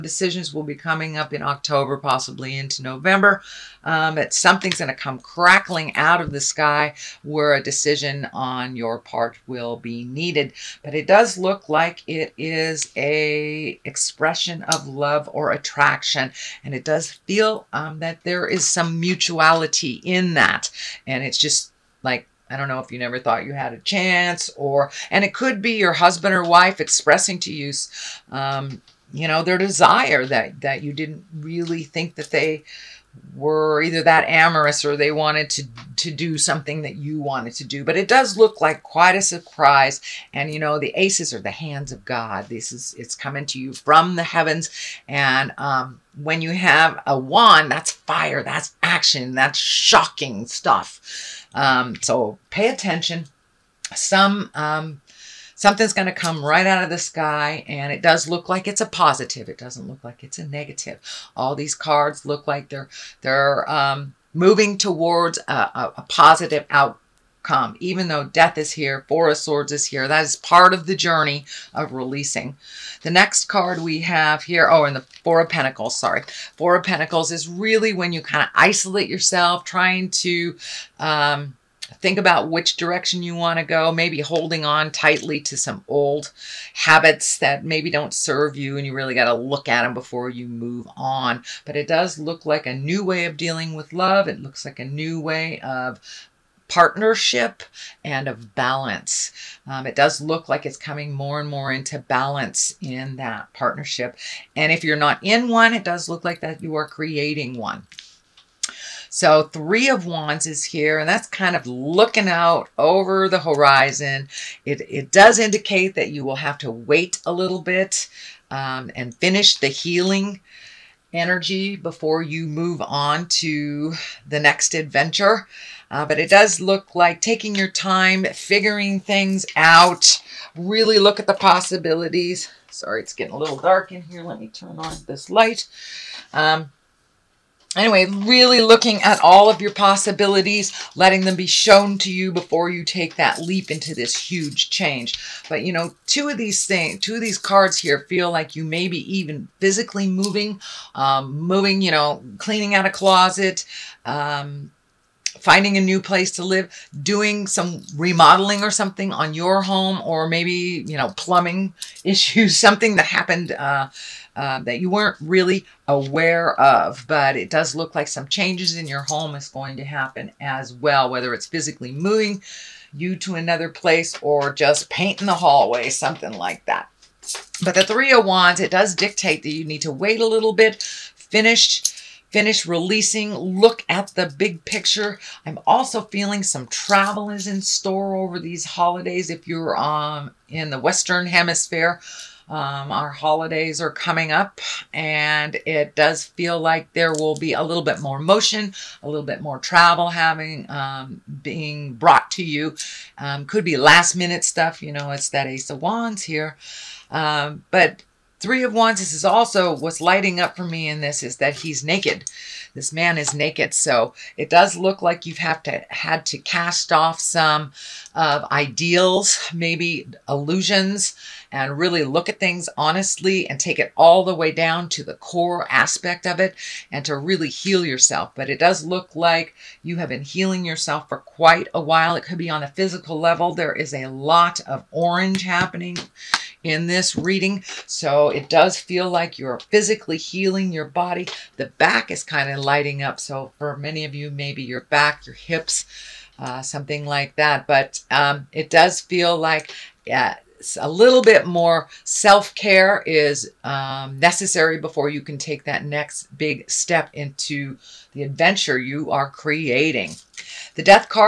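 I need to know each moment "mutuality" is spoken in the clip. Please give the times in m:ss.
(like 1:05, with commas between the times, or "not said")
0:18.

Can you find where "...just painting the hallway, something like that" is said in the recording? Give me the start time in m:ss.
2:54.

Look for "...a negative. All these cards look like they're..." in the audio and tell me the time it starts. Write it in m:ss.
1:00.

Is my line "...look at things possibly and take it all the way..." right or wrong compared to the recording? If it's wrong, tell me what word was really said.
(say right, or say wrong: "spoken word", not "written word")
wrong: "honestly", not "possibly".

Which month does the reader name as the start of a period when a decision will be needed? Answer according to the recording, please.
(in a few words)
October.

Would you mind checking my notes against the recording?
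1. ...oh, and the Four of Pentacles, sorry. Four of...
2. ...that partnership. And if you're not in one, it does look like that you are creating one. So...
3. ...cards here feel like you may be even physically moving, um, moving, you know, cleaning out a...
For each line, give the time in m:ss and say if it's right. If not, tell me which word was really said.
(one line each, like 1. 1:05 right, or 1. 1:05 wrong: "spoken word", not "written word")
1. 1:14 right
2. 1:43 right
3. 2:27 right.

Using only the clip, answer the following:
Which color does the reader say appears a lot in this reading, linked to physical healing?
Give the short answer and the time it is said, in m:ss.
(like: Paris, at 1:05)
Orange, at 3:54.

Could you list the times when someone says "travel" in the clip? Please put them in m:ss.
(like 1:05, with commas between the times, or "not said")
3:06, 3:19.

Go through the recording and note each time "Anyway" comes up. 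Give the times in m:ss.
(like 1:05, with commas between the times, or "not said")
2:17.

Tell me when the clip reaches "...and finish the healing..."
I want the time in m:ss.
1:58.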